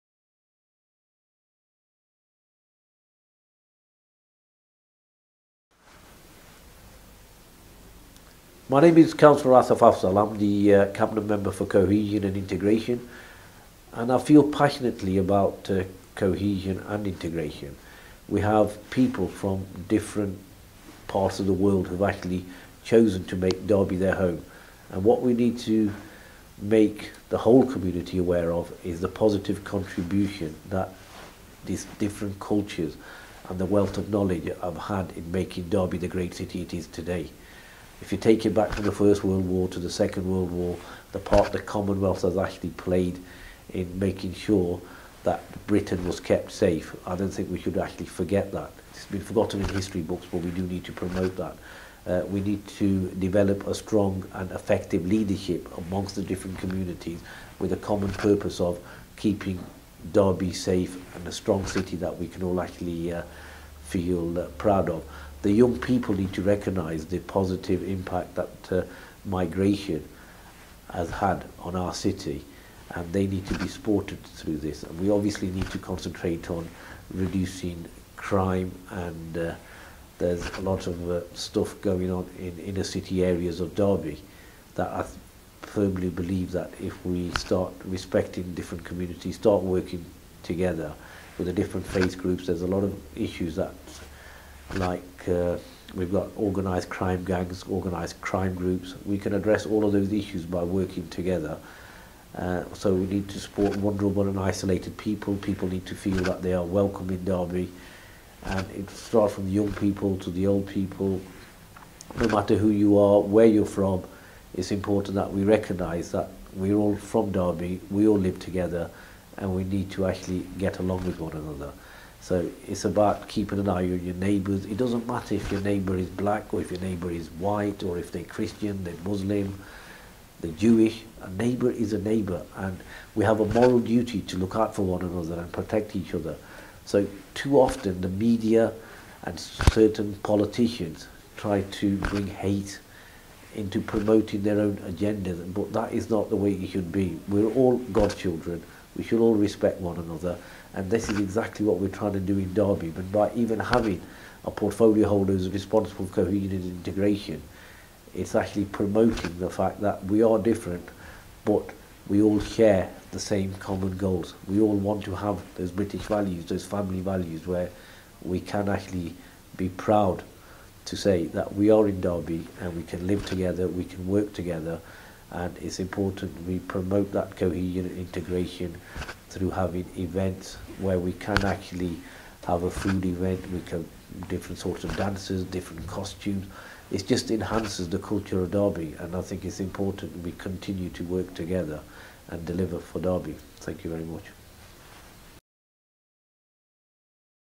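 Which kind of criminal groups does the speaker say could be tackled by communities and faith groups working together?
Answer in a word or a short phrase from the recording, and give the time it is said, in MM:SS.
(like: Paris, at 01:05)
Organised crime gangs, at 01:36.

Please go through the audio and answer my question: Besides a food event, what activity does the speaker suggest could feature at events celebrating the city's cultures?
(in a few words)
Dances.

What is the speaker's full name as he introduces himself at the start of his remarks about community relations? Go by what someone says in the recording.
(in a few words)
Asaf Afzal.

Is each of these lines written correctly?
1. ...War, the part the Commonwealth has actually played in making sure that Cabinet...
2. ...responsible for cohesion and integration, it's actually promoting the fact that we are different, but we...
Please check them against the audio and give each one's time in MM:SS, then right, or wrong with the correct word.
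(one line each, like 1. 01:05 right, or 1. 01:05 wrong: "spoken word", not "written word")
1. 00:40 wrong: "Britain", not "Cabinet"
2. 02:35 right.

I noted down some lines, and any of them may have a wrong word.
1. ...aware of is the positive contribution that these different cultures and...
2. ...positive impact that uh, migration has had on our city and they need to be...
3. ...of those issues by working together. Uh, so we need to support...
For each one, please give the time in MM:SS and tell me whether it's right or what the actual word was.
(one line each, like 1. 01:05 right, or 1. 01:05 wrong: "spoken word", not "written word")
1. 00:28 right
2. 01:07 right
3. 01:39 right.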